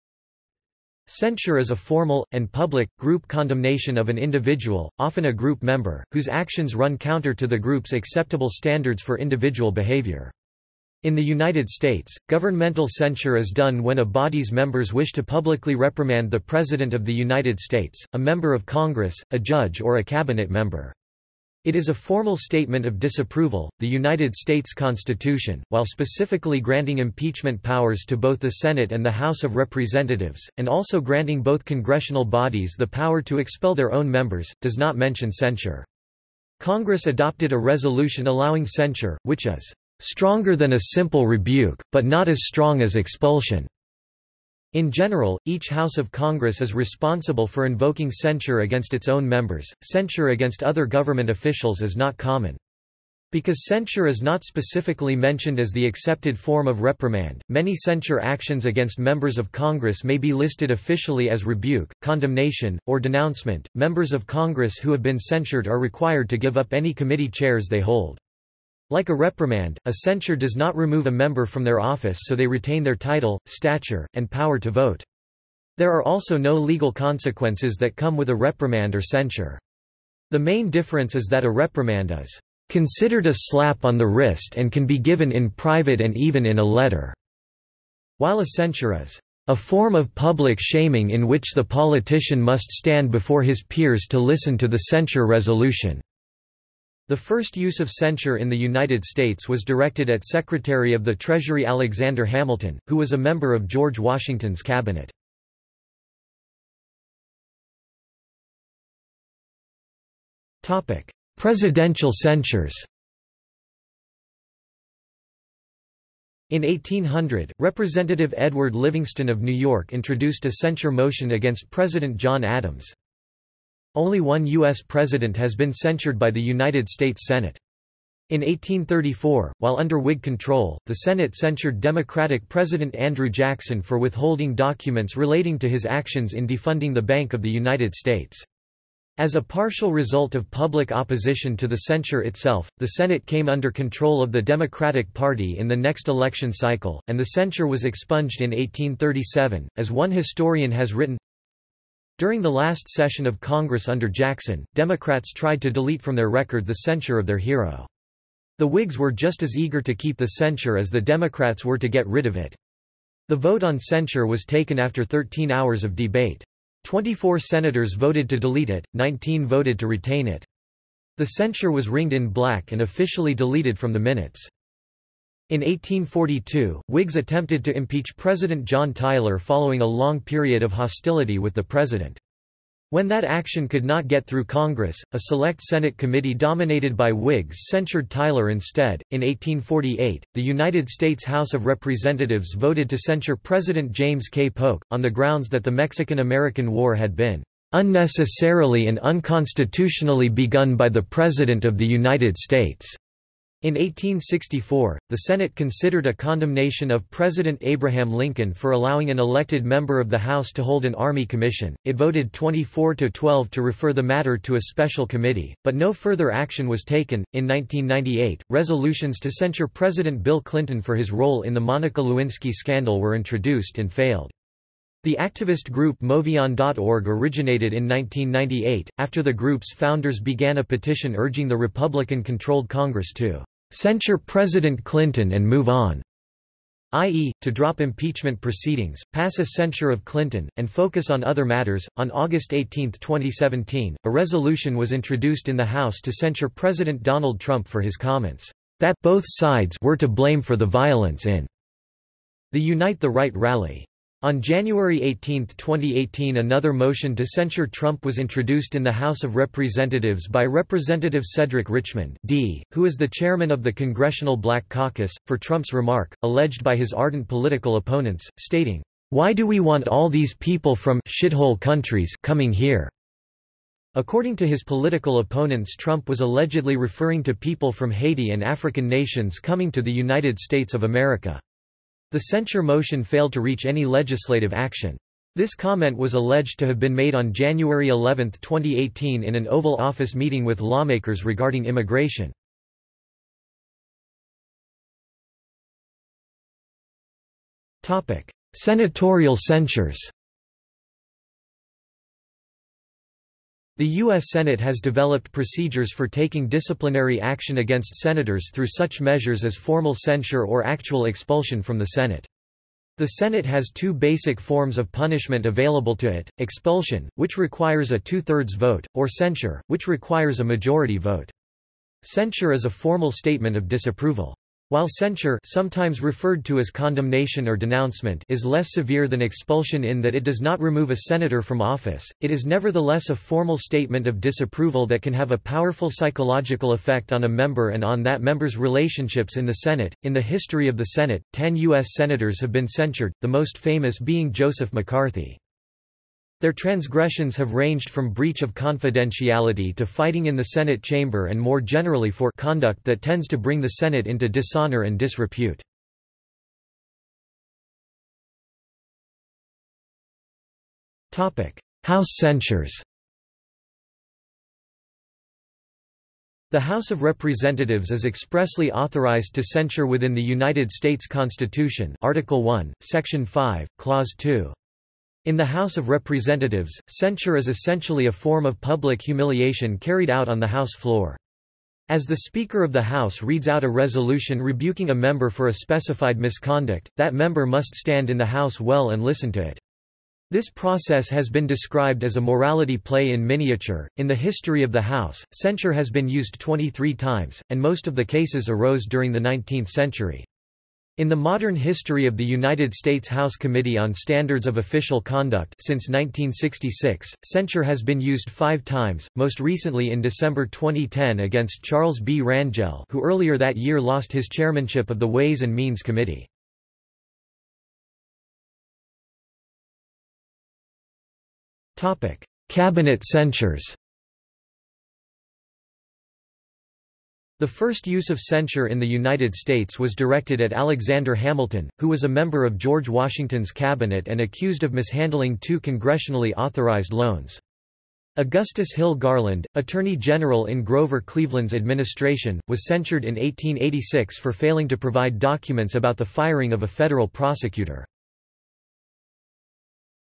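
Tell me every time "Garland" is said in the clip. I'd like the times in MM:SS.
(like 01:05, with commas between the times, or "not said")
07:18.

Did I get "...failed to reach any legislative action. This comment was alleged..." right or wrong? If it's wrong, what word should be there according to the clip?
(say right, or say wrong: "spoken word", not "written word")
right.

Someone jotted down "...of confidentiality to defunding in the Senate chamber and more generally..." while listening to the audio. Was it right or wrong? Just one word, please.
wrong.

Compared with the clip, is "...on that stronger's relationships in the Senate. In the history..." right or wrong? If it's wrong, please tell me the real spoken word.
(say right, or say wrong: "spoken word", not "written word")
wrong: "member", not "stronger".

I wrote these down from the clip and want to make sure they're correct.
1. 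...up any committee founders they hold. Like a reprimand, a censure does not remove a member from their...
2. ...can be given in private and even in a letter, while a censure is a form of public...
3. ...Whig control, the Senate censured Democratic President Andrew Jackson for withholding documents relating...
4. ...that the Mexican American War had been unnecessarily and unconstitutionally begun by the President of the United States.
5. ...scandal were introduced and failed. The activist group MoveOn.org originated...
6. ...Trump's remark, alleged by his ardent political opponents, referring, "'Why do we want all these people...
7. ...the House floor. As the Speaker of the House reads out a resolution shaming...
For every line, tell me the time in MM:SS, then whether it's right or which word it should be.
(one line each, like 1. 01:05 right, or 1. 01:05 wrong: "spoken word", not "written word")
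1. 01:06 wrong: "chairs", not "founders"
2. 01:24 right
3. 02:09 right
4. 03:15 right
5. 03:42 right
6. 04:25 wrong: "stating", not "referring"
7. 06:20 wrong: "rebuking", not "shaming".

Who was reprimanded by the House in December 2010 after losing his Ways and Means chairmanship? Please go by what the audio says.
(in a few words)
Charles B. Rangel.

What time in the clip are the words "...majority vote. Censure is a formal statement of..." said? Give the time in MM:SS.
05:20.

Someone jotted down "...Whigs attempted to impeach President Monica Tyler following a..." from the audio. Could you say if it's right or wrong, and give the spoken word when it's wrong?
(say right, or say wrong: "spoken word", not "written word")
wrong: "John", not "Monica".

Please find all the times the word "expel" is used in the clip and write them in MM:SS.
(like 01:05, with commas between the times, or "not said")
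00:33.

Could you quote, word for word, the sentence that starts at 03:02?
When that action could not get through Congress, a select Senate committee dominated by Whigs censured Tyler instead.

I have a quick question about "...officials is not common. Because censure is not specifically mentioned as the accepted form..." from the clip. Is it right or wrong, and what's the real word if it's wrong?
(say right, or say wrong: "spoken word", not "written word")
right.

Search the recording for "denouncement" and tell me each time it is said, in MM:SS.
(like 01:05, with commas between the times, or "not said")
01:03, 05:27.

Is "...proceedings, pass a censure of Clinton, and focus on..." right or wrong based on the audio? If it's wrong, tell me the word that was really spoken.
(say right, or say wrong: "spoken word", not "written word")
right.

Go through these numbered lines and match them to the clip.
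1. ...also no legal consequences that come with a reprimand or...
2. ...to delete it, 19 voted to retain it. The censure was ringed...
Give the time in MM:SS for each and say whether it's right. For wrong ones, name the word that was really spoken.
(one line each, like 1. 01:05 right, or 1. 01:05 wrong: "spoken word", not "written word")
1. 01:16 right
2. 02:48 right.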